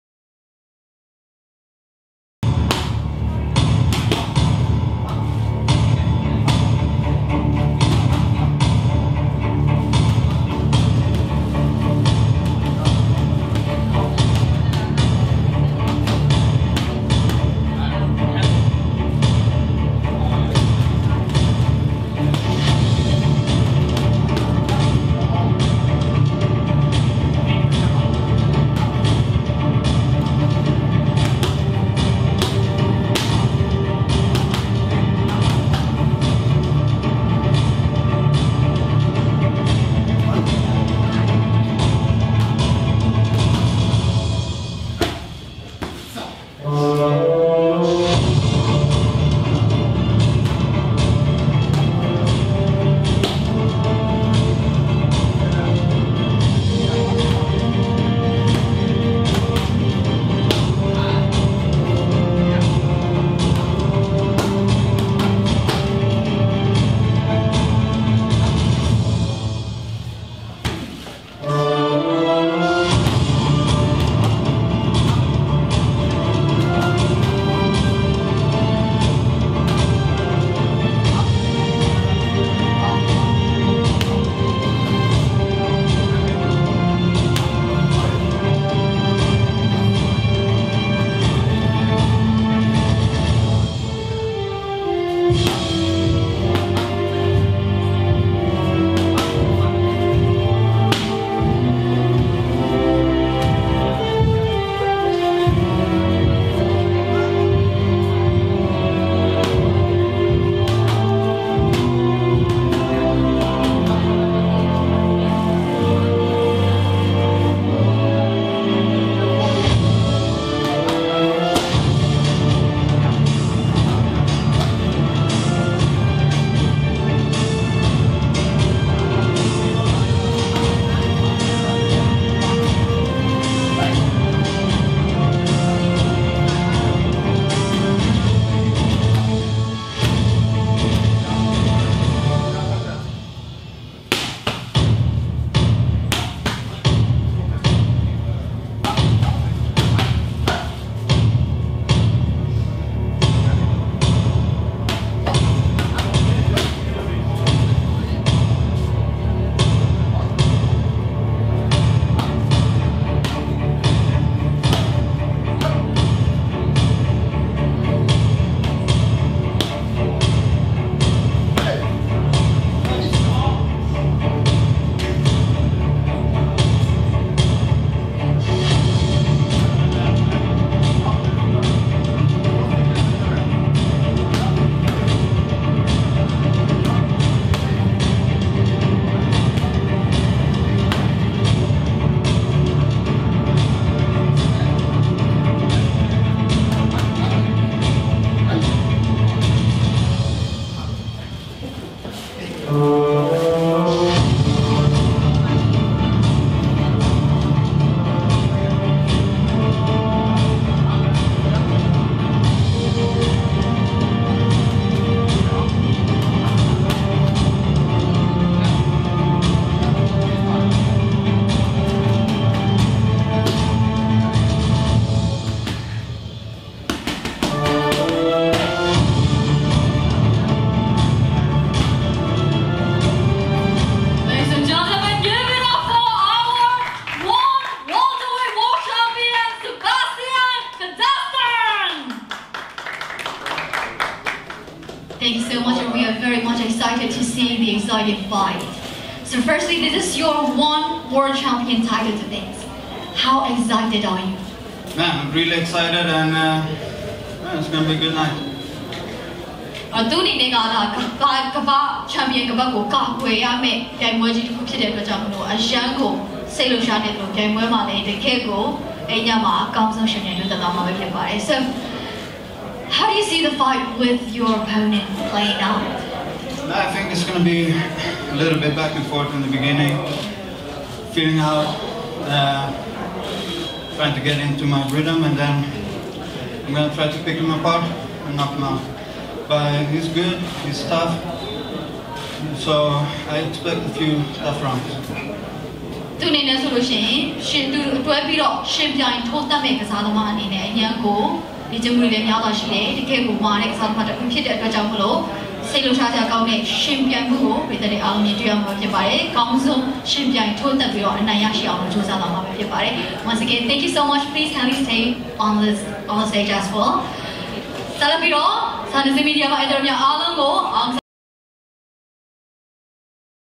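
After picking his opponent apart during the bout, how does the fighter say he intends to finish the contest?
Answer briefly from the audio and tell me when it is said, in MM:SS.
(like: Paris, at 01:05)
Knock him out, at 04:48.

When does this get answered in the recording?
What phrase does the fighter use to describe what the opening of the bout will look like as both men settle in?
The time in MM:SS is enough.
04:38.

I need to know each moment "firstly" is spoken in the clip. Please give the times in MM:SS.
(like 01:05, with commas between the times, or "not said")
04:09.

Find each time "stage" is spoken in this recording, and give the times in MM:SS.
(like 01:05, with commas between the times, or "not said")
05:16.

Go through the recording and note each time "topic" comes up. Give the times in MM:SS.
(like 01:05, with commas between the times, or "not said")
not said.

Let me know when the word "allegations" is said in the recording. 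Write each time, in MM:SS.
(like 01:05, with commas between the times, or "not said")
not said.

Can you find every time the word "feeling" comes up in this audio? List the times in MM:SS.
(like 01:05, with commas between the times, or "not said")
04:41.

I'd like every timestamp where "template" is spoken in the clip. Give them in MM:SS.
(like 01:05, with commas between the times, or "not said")
not said.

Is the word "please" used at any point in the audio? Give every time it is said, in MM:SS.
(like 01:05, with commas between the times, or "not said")
05:14.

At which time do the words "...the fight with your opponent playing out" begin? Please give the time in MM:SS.
04:33.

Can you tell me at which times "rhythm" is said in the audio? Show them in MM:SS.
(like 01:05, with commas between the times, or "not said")
04:44.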